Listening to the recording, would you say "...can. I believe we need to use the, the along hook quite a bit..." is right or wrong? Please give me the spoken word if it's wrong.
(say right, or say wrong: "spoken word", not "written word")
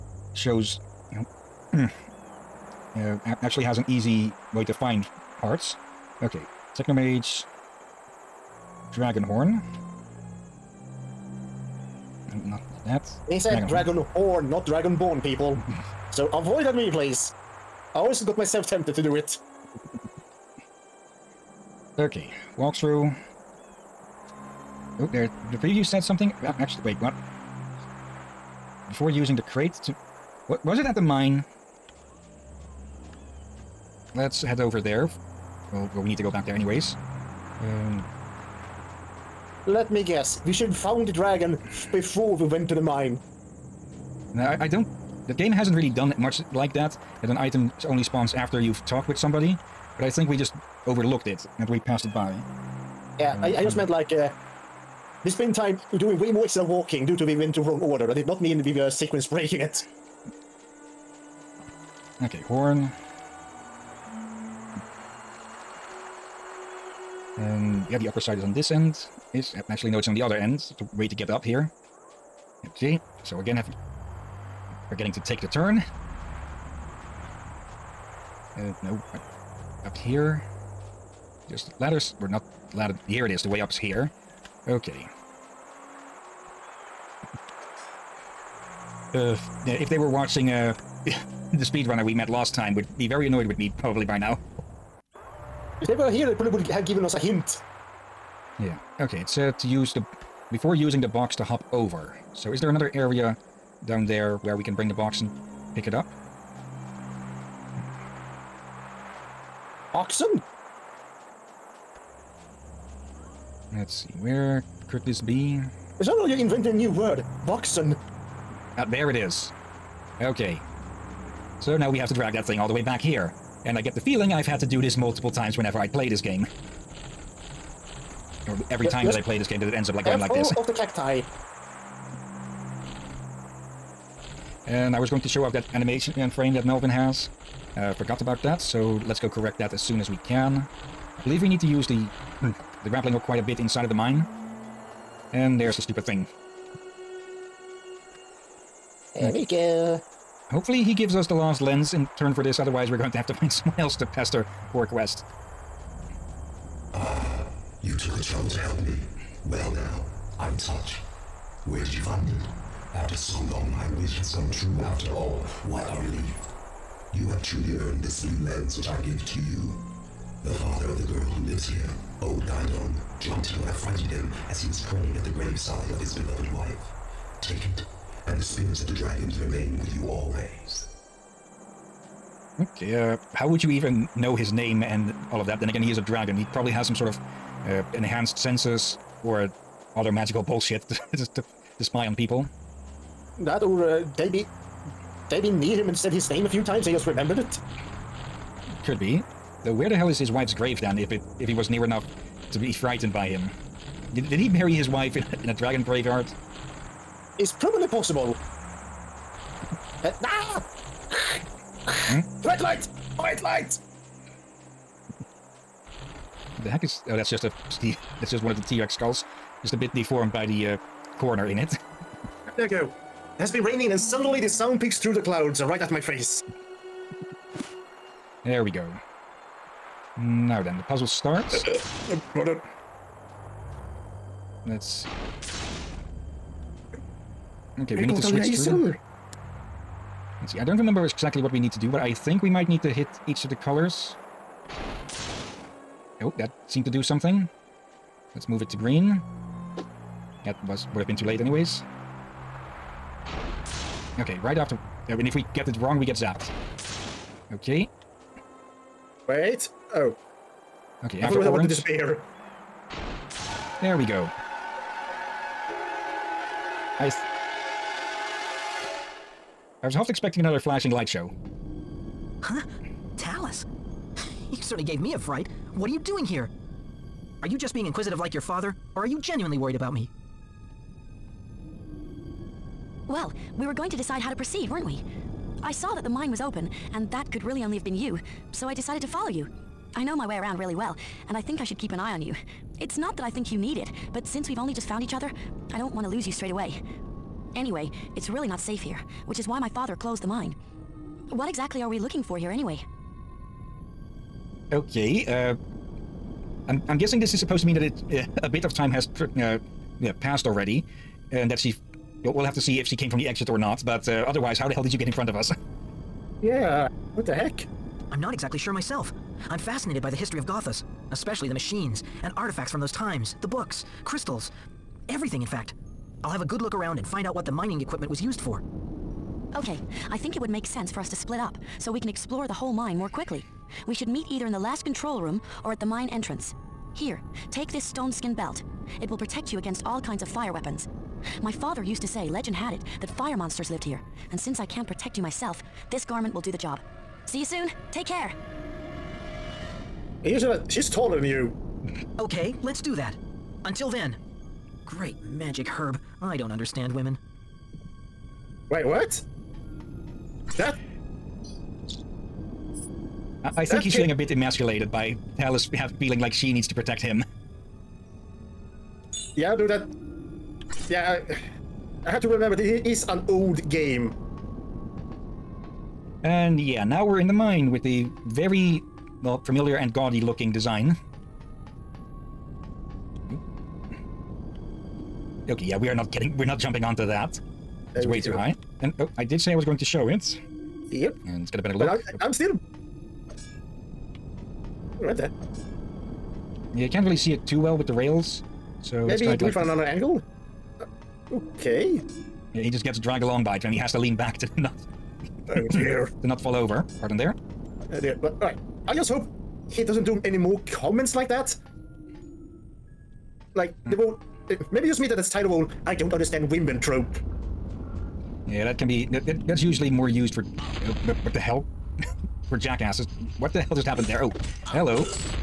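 wrong: "grappling", not "along".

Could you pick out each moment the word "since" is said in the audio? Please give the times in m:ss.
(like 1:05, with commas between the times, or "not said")
4:54, 5:44.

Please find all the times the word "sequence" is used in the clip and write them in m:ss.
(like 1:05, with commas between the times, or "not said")
0:58.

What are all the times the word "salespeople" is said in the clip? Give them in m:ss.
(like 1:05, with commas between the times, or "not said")
not said.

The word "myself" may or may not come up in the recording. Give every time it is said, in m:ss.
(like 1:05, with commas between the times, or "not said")
0:18, 5:18, 5:45.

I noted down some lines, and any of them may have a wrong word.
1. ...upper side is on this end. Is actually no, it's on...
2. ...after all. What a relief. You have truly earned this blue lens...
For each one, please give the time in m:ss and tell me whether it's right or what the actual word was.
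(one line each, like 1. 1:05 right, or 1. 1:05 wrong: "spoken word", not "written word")
1. 1:08 right
2. 2:44 right.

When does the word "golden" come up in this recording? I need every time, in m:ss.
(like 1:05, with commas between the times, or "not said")
not said.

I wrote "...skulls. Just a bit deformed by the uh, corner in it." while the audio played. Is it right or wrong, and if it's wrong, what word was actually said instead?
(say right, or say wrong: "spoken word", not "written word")
right.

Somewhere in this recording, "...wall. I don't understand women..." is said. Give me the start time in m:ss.
6:55.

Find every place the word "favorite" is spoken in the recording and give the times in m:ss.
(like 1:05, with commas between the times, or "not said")
not said.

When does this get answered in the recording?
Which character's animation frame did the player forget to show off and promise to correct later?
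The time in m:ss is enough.
2:16.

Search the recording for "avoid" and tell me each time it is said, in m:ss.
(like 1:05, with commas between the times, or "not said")
0:16.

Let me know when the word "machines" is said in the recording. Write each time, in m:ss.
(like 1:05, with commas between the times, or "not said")
5:21.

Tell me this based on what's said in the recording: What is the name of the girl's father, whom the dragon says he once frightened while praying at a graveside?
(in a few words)
Gaidon.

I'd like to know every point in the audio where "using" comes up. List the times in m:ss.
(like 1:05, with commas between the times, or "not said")
0:29, 1:40.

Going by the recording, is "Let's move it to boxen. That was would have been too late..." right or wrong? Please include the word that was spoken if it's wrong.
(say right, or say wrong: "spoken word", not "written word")
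wrong: "green", not "boxen".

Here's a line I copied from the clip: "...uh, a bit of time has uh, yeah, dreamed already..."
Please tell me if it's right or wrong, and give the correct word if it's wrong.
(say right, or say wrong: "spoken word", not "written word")
wrong: "passed", not "dreamed".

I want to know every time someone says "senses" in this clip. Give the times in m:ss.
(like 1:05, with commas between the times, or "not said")
3:08, 5:30.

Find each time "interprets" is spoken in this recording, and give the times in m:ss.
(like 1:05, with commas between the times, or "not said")
not said.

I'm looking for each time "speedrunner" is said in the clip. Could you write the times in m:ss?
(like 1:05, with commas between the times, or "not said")
1:31.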